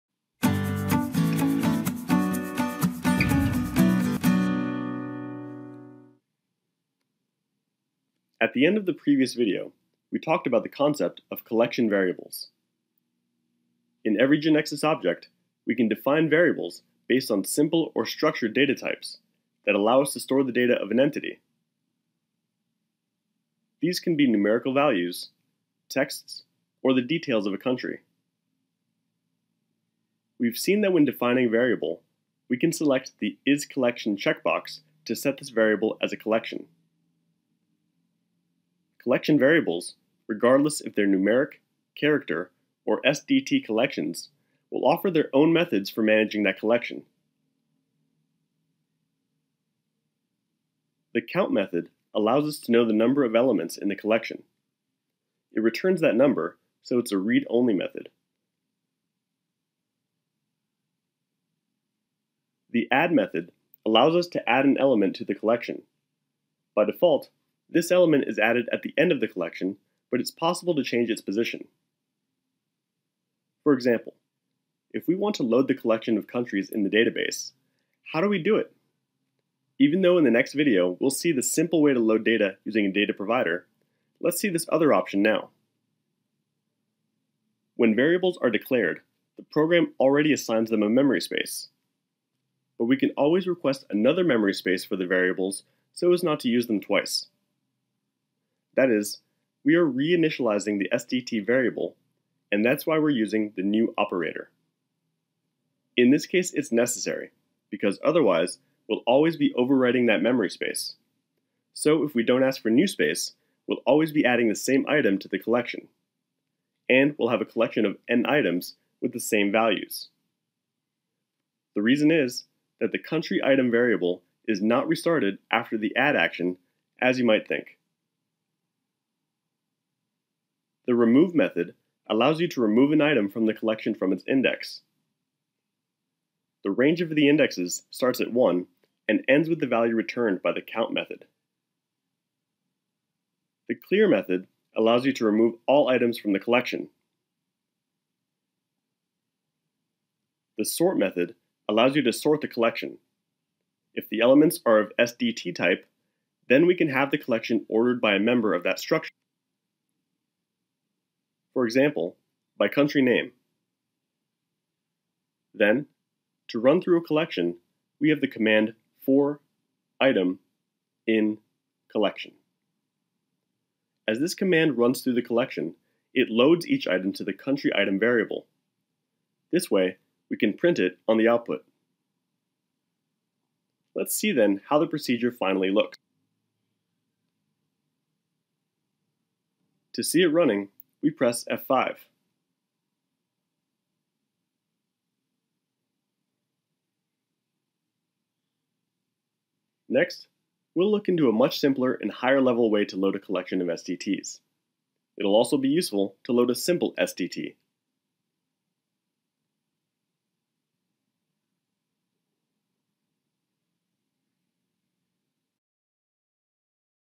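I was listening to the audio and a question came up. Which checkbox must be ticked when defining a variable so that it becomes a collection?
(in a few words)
Is Collection.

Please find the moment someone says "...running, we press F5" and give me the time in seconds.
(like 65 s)
190 s.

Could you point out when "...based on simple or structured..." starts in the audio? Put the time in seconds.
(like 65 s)
17 s.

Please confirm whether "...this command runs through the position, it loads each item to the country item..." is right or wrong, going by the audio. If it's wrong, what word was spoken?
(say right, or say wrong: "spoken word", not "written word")
wrong: "collection", not "position".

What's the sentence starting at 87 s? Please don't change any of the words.
When variables are declared, the program already assigns them a memory space.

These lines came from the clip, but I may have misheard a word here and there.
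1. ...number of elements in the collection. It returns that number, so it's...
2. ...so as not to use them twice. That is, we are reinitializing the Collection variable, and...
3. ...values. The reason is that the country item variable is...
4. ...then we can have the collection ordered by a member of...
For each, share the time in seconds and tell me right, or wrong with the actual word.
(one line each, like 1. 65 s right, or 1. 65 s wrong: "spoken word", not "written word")
1. 52 s right
2. 95 s wrong: "SDT", not "Collection"
3. 119 s right
4. 156 s right.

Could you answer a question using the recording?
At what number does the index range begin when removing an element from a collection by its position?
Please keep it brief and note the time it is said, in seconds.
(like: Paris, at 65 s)
1, at 137 s.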